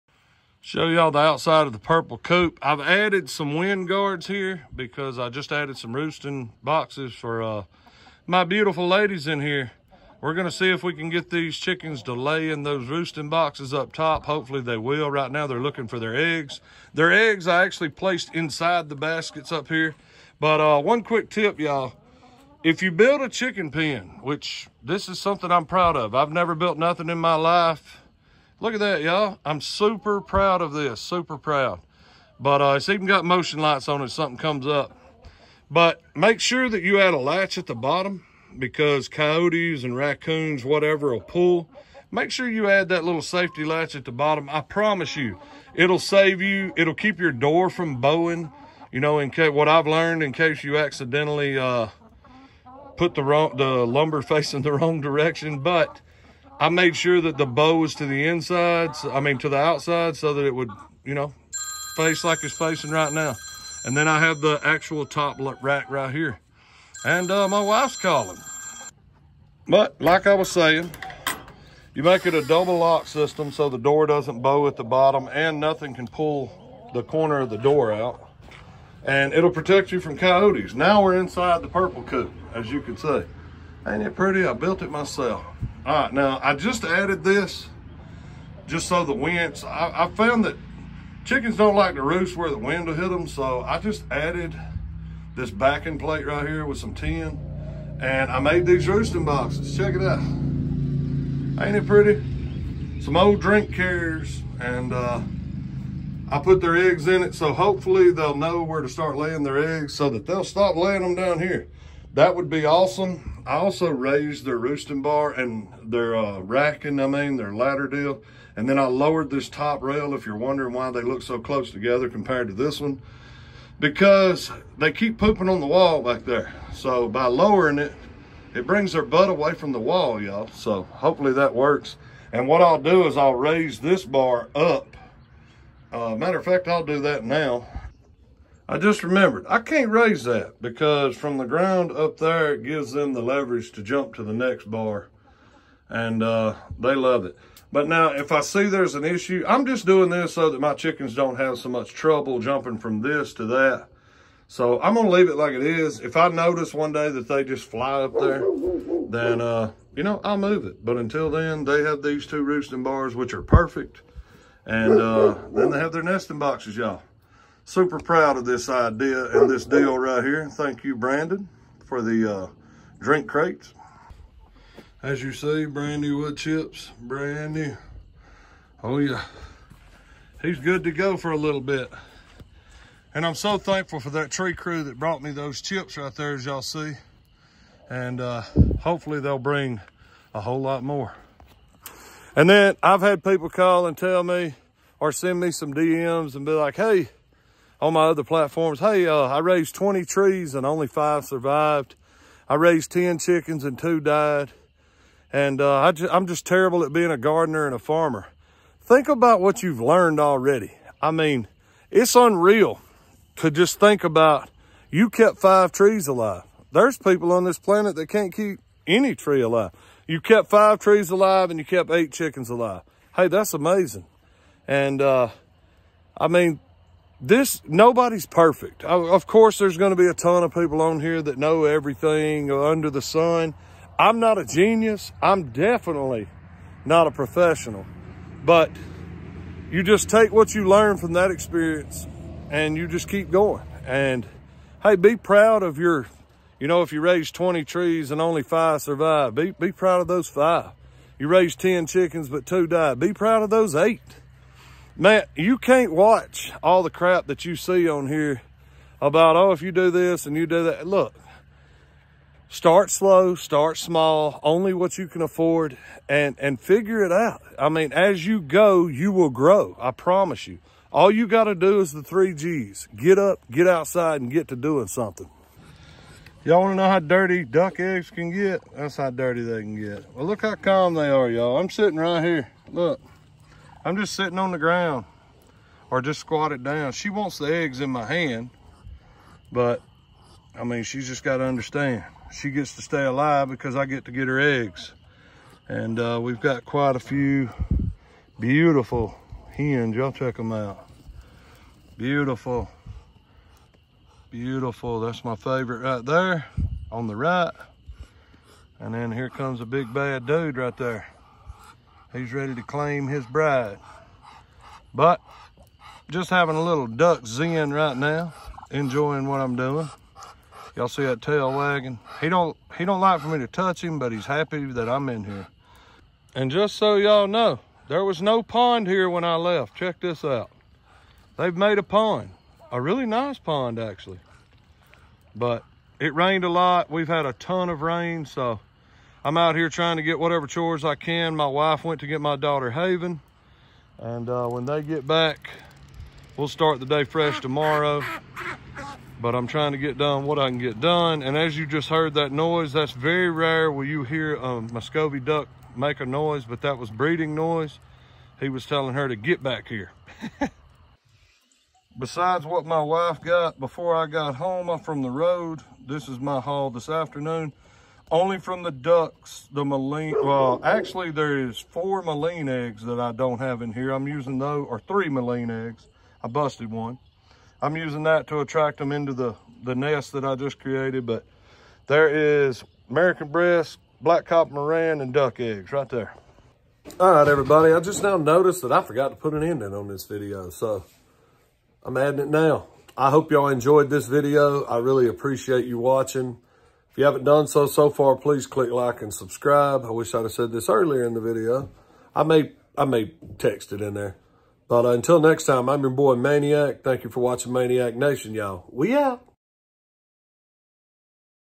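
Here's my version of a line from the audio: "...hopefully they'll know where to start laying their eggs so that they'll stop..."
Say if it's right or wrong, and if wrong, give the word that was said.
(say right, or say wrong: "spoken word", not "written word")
right.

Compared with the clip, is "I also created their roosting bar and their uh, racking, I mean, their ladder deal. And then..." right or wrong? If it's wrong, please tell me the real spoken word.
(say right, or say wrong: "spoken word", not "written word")
wrong: "raised", not "created".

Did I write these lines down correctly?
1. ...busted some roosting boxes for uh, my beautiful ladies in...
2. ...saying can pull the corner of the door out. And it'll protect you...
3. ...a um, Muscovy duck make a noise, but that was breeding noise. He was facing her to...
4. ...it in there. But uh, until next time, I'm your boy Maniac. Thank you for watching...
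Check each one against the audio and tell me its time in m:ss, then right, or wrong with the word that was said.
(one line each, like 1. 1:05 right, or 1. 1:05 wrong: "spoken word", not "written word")
1. 0:05 wrong: "added", not "busted"
2. 1:15 wrong: "nothing", not "saying"
3. 5:54 wrong: "telling", not "facing"
4. 6:43 right.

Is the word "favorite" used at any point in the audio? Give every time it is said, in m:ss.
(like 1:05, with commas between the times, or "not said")
5:05.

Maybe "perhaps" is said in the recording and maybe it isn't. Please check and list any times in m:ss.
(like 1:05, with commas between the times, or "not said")
not said.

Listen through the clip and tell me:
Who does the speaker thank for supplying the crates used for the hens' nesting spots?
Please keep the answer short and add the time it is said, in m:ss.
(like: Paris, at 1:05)
Brandon, at 2:50.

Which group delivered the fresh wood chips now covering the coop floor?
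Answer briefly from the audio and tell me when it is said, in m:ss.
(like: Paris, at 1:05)
Tree crew, at 3:04.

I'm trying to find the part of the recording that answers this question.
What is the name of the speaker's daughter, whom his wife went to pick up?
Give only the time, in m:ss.
5:42.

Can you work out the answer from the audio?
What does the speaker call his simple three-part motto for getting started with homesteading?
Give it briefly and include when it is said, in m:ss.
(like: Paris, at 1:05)
The three G's, at 4:31.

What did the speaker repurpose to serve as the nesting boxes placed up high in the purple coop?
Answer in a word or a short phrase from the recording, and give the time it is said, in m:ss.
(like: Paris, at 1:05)
Old drink carriers, at 1:43.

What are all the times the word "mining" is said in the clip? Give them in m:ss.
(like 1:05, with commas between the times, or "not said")
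not said.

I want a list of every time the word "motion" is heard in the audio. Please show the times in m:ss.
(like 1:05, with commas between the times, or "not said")
0:33.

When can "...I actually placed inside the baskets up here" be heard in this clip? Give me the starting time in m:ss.
0:17.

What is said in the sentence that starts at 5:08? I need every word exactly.
And then here comes a big bad dude right there.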